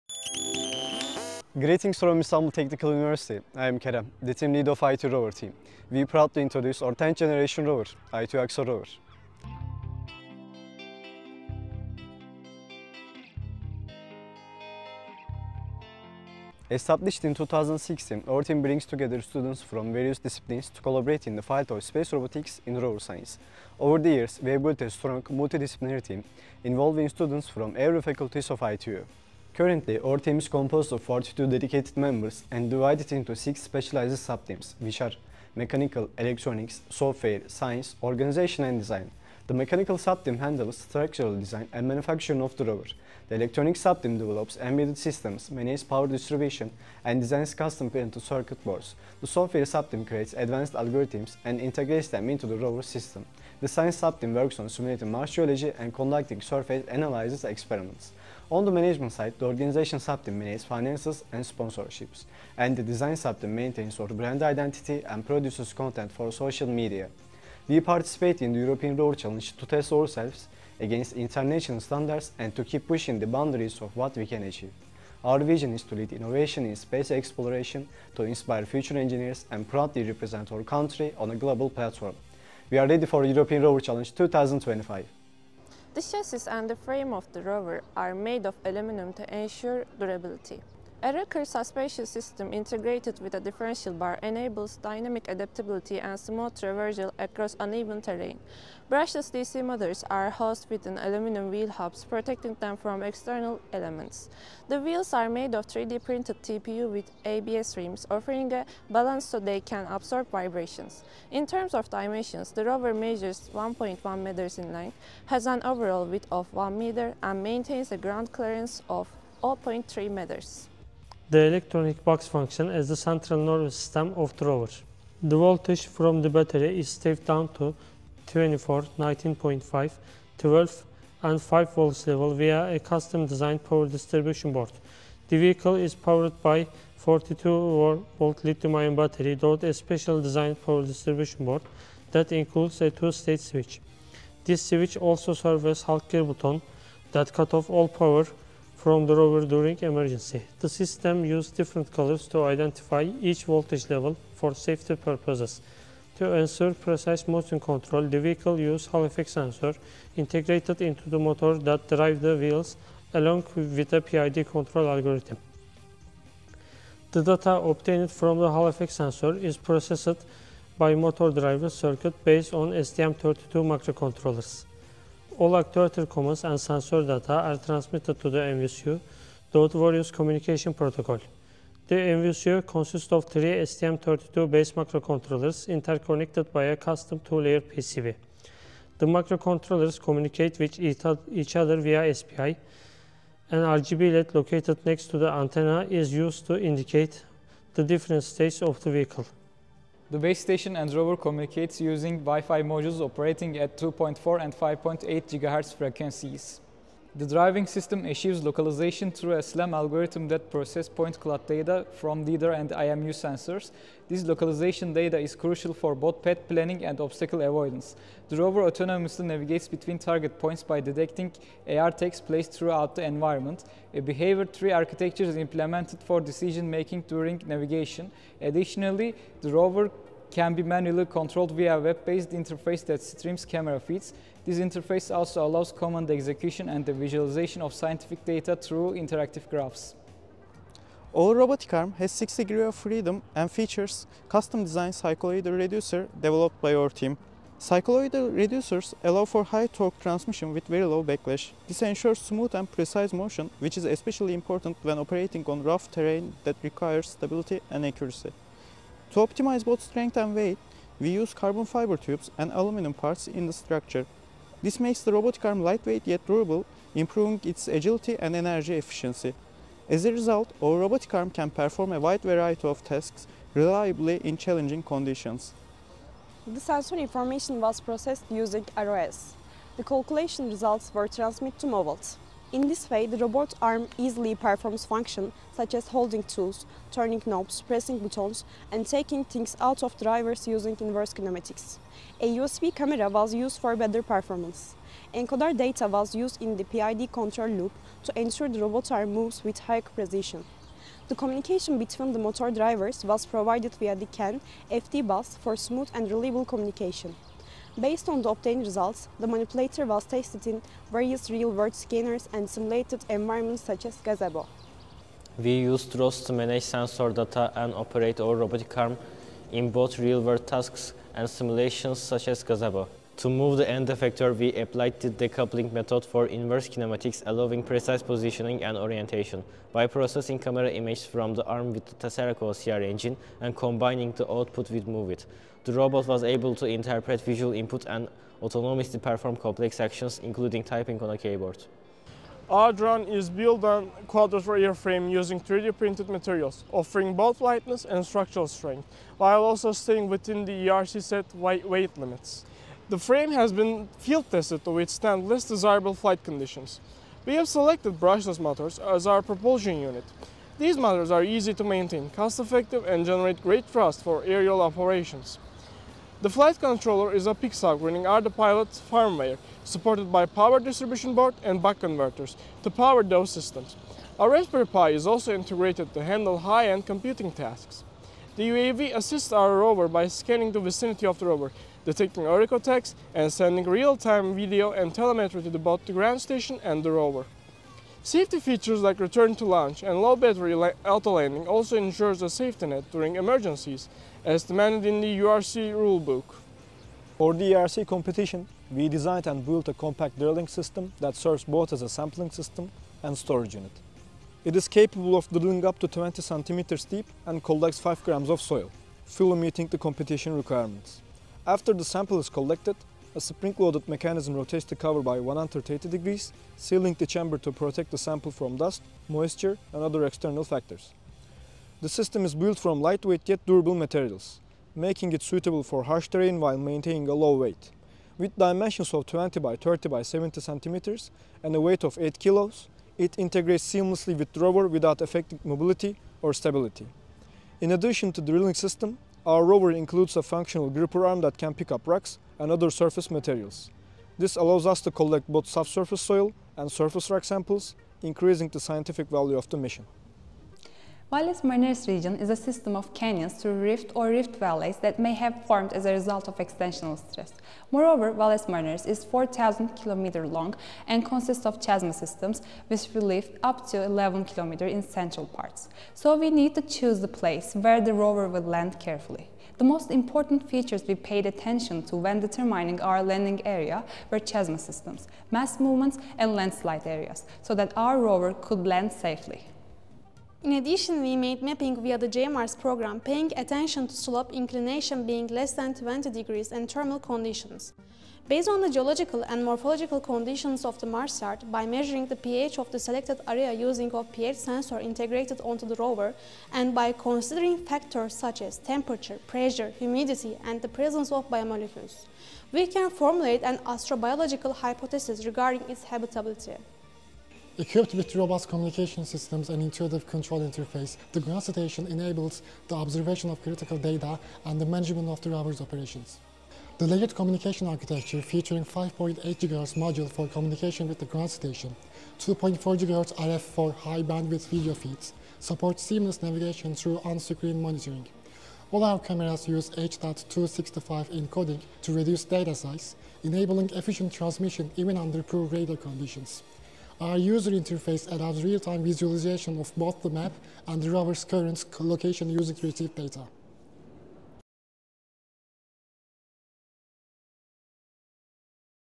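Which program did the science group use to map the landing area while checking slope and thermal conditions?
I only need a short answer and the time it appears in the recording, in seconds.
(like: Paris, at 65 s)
JMARS, at 482 s.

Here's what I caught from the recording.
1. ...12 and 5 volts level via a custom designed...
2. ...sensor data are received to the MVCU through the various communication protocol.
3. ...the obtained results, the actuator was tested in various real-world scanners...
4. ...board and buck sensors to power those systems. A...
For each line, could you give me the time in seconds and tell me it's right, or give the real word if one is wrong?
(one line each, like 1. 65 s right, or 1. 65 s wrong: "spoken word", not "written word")
1. 130 s right
2. 176 s wrong: "transmitted", not "received"
3. 308 s wrong: "manipulator", not "actuator"
4. 371 s wrong: "converters", not "sensors".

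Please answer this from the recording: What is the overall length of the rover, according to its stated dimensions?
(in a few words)
1.1 meters.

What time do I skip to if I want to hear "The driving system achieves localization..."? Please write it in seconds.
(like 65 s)
207 s.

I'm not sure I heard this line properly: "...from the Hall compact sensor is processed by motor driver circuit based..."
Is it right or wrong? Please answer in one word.
wrong.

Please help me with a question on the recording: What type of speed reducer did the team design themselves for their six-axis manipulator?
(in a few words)
cycloidal reducer.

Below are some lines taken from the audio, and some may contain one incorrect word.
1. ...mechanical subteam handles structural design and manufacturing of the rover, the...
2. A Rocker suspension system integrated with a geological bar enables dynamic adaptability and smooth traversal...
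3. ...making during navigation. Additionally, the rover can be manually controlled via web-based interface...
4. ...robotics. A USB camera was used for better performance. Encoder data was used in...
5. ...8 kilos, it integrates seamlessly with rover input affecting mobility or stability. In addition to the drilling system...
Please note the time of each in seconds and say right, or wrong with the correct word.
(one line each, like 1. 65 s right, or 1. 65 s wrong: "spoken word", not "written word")
1. 39 s right
2. 91 s wrong: "differential", not "geological"
3. 226 s right
4. 291 s wrong: "kinematics", not "robotics"
5. 431 s wrong: "without", not "input".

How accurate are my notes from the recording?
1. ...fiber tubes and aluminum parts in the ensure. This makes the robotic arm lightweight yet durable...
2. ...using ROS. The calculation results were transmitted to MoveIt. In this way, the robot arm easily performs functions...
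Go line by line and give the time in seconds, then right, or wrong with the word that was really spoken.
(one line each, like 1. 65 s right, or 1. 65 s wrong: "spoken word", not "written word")
1. 261 s wrong: "structure", not "ensure"
2. 278 s right.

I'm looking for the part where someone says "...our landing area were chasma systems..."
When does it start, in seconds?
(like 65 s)
472 s.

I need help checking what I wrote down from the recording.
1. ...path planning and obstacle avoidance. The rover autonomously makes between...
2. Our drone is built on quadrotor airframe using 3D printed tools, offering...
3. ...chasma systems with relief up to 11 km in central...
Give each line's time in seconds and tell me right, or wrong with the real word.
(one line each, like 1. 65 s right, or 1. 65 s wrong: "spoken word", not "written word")
1. 216 s wrong: "navigates", not "makes"
2. 342 s wrong: "materials", not "tools"
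3. 461 s right.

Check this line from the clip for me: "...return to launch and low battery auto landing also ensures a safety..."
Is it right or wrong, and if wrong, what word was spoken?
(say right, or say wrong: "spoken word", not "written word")
right.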